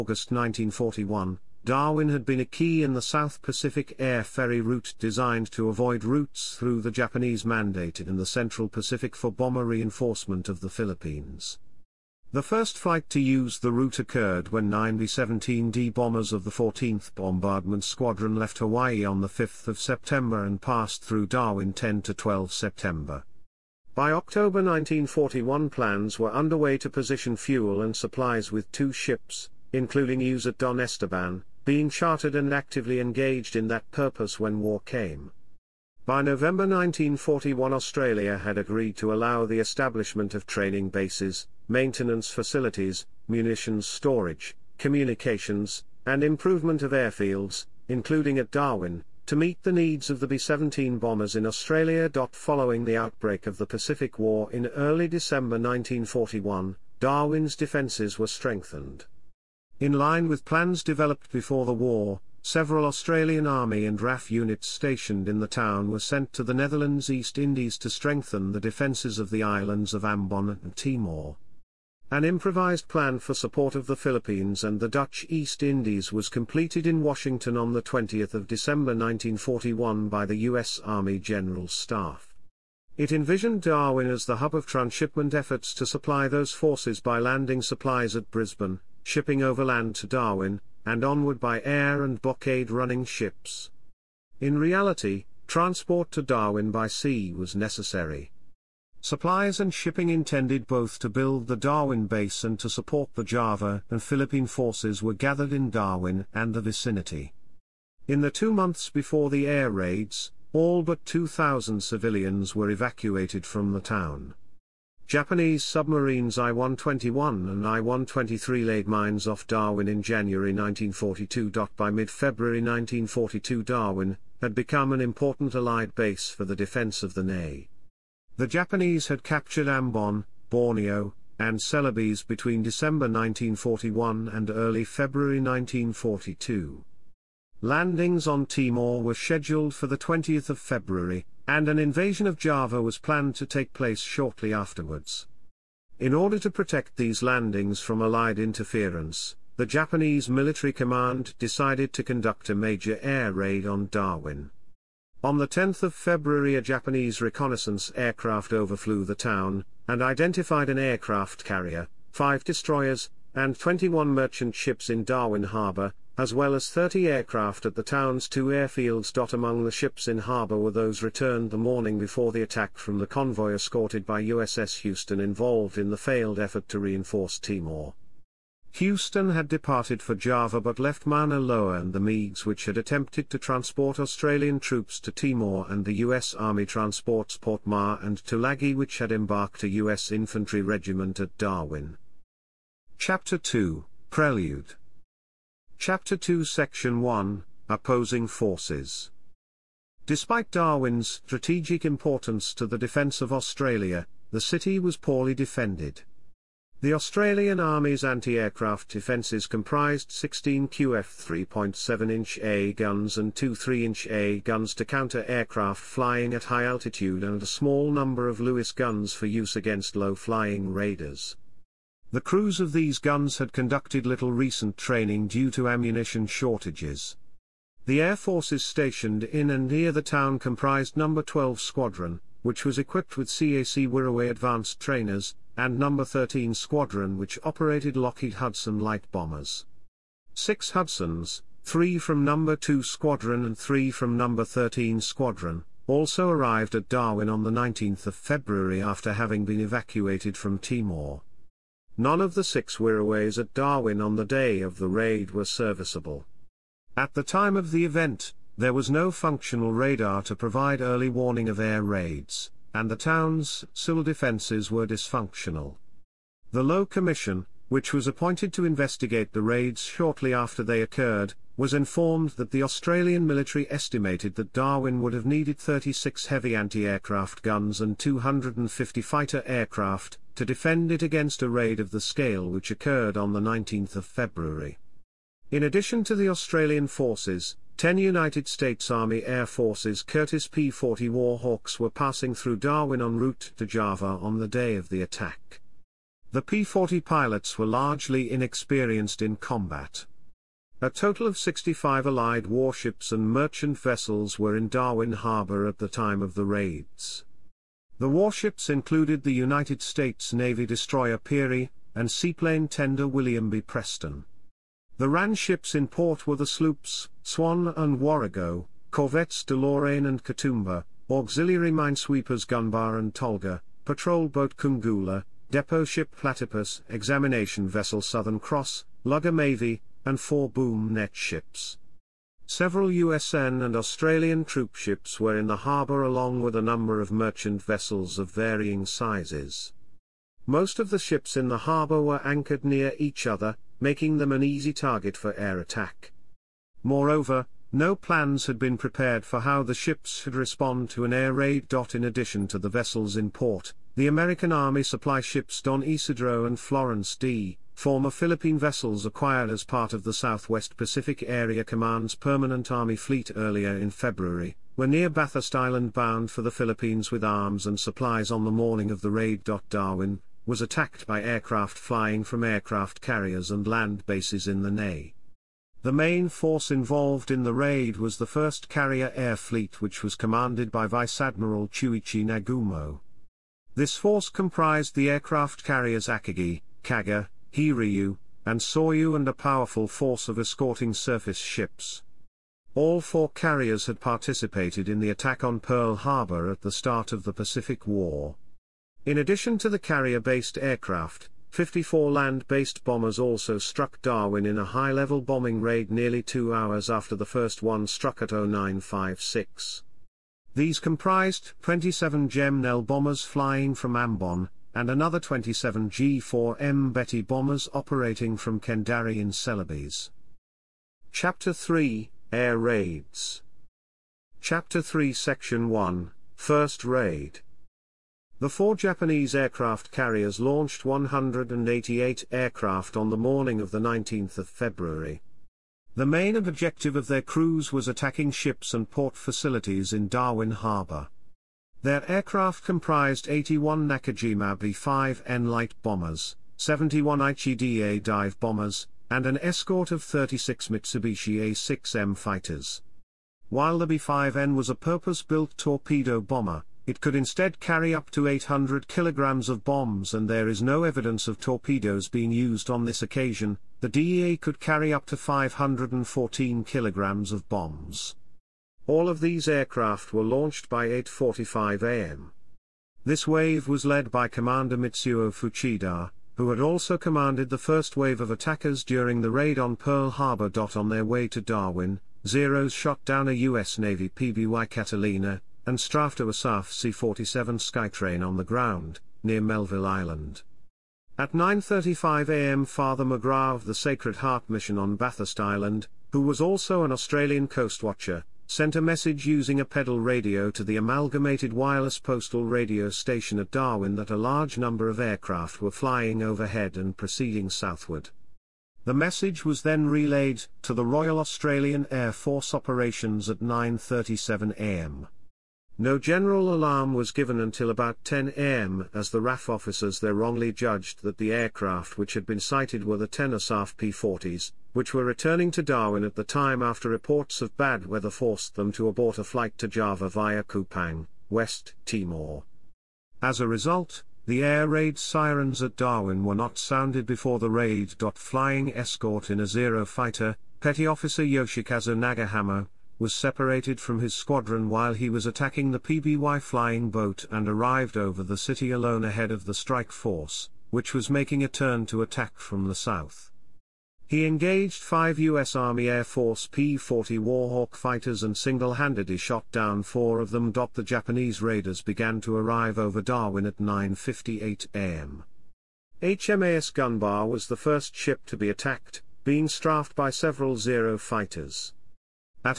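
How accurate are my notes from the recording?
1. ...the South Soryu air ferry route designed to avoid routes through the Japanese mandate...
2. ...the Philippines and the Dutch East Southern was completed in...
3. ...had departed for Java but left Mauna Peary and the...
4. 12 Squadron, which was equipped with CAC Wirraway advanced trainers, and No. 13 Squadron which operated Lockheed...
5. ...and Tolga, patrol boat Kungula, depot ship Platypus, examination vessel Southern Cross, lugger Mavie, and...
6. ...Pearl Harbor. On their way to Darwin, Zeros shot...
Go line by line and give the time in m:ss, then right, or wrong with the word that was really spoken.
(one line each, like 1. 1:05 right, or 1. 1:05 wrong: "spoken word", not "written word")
1. 0:02 wrong: "Pacific", not "Soryu"
2. 1:13 wrong: "Indies", not "Southern"
3. 2:59 wrong: "Loa", not "Peary"
4. 3:51 right
5. 5:22 right
6. 7:59 right.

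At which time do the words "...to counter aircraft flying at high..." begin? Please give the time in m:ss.
3:34.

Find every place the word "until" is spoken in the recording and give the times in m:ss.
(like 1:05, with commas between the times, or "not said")
8:37.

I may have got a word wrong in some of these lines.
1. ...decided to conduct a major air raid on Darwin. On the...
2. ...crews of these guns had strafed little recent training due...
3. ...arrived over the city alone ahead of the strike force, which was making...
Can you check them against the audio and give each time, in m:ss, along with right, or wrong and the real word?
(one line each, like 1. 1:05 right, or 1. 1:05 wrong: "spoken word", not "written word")
1. 2:31 right
2. 3:42 wrong: "conducted", not "strafed"
3. 9:07 right.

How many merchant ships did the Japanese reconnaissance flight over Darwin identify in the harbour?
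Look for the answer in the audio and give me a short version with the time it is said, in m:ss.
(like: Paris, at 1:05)
21, at 2:43.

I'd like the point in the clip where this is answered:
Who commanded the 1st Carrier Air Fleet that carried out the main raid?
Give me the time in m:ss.
6:21.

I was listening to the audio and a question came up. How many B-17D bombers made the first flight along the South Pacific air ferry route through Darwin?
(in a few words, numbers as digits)
9.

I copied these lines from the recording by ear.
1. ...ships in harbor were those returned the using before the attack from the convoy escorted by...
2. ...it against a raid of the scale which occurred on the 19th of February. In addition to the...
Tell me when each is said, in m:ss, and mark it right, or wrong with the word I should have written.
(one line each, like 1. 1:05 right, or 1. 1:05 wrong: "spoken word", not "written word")
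1. 2:49 wrong: "morning", not "using"
2. 4:40 right.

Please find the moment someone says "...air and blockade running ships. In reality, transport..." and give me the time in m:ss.
1:31.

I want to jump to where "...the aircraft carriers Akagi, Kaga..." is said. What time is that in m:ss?
6:24.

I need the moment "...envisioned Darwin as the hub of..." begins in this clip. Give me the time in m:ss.
1:23.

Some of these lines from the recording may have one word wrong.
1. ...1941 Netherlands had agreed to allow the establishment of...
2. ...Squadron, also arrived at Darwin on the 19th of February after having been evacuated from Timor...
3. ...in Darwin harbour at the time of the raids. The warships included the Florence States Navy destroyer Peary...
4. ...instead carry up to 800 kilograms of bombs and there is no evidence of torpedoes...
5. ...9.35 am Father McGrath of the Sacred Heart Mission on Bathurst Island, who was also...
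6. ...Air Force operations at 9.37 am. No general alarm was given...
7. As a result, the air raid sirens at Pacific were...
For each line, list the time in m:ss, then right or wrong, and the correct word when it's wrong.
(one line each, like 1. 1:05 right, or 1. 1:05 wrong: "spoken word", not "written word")
1. 0:36 wrong: "Australia", not "Netherlands"
2. 4:05 right
3. 5:04 wrong: "United", not "Florence"
4. 7:37 right
5. 8:11 right
6. 8:31 right
7. 8:53 wrong: "Darwin", not "Pacific".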